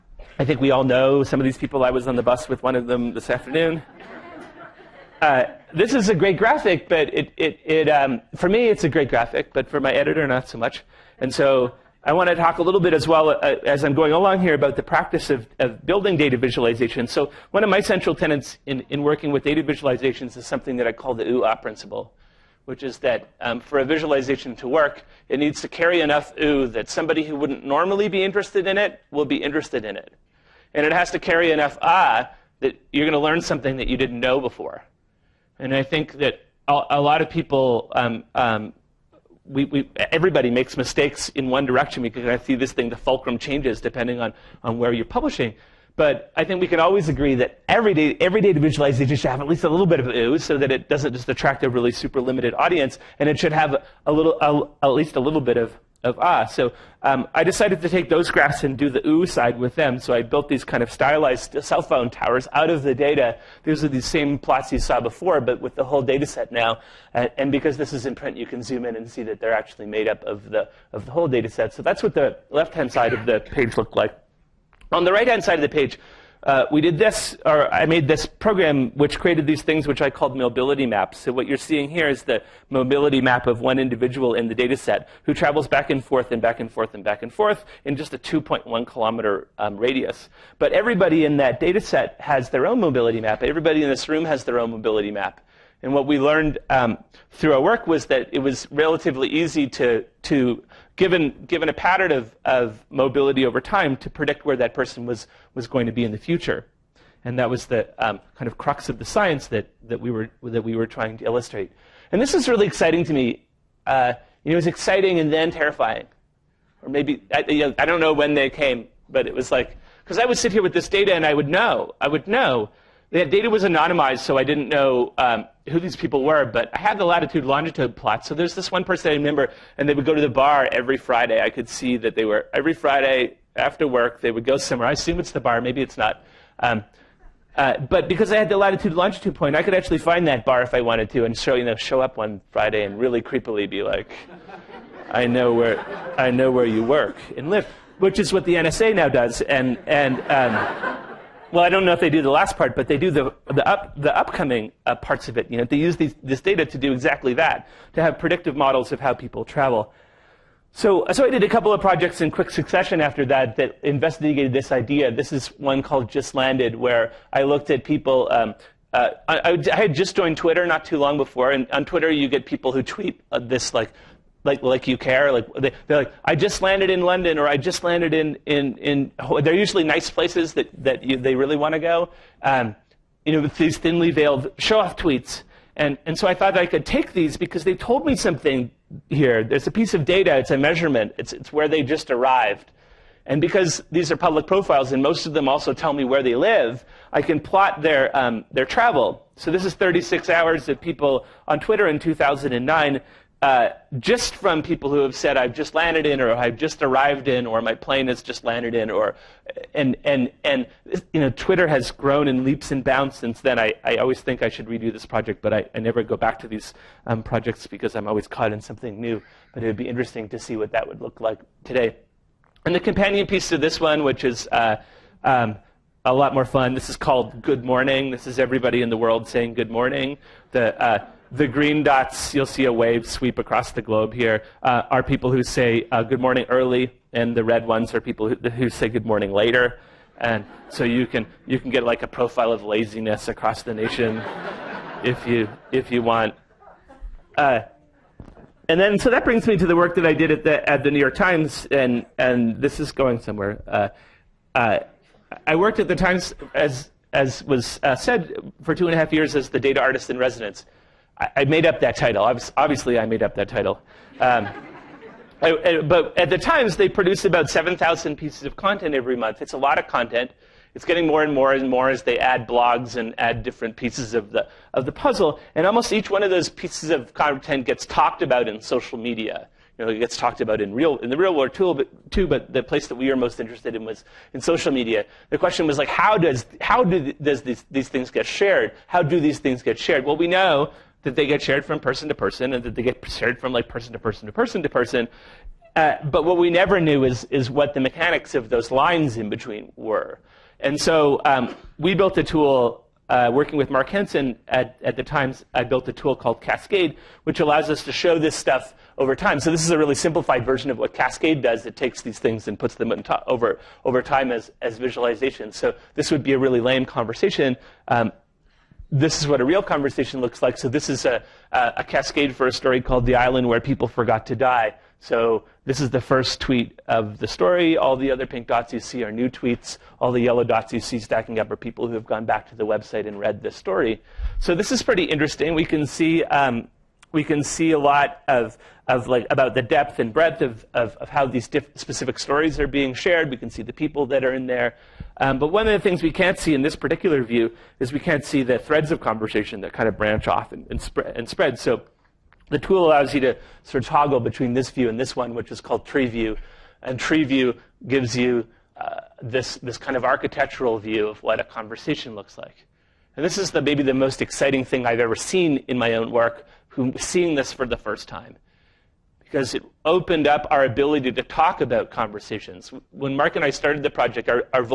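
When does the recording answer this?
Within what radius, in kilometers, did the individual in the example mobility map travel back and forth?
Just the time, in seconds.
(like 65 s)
88 s.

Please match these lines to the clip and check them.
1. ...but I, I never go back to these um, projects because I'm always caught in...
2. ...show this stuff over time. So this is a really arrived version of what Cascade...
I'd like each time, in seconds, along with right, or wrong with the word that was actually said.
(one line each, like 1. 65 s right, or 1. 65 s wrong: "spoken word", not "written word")
1. 215 s right
2. 307 s wrong: "simplified", not "arrived".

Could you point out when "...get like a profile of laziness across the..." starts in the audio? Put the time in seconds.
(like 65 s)
241 s.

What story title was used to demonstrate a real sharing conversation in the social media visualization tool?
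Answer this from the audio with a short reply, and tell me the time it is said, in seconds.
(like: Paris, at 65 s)
The Island Where People Forgot to Die, at 323 s.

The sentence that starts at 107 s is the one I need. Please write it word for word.
And that was the um, kind of crux of the science that, that, we were, that we were trying to illustrate.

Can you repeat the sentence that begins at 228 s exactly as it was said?
This is everybody in the world saying good morning.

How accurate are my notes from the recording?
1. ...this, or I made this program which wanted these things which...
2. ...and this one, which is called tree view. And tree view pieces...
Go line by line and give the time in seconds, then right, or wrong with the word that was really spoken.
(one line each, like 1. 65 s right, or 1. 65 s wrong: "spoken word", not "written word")
1. 76 s wrong: "created", not "wanted"
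2. 354 s wrong: "gives", not "pieces".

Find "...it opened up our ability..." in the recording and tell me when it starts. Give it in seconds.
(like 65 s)
369 s.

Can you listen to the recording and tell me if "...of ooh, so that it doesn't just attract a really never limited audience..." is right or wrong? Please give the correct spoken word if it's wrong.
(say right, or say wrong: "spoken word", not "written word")
wrong: "super", not "never".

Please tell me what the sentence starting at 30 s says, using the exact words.
And it has to carry enough ah that you're going to learn something that you didn't know before.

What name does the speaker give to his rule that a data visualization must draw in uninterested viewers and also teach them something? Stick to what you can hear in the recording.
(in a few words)
OOH principle.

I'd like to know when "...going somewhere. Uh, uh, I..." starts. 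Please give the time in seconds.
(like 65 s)
252 s.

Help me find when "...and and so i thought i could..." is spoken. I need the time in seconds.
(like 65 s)
185 s.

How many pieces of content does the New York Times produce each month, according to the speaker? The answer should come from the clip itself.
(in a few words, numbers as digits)
7,000.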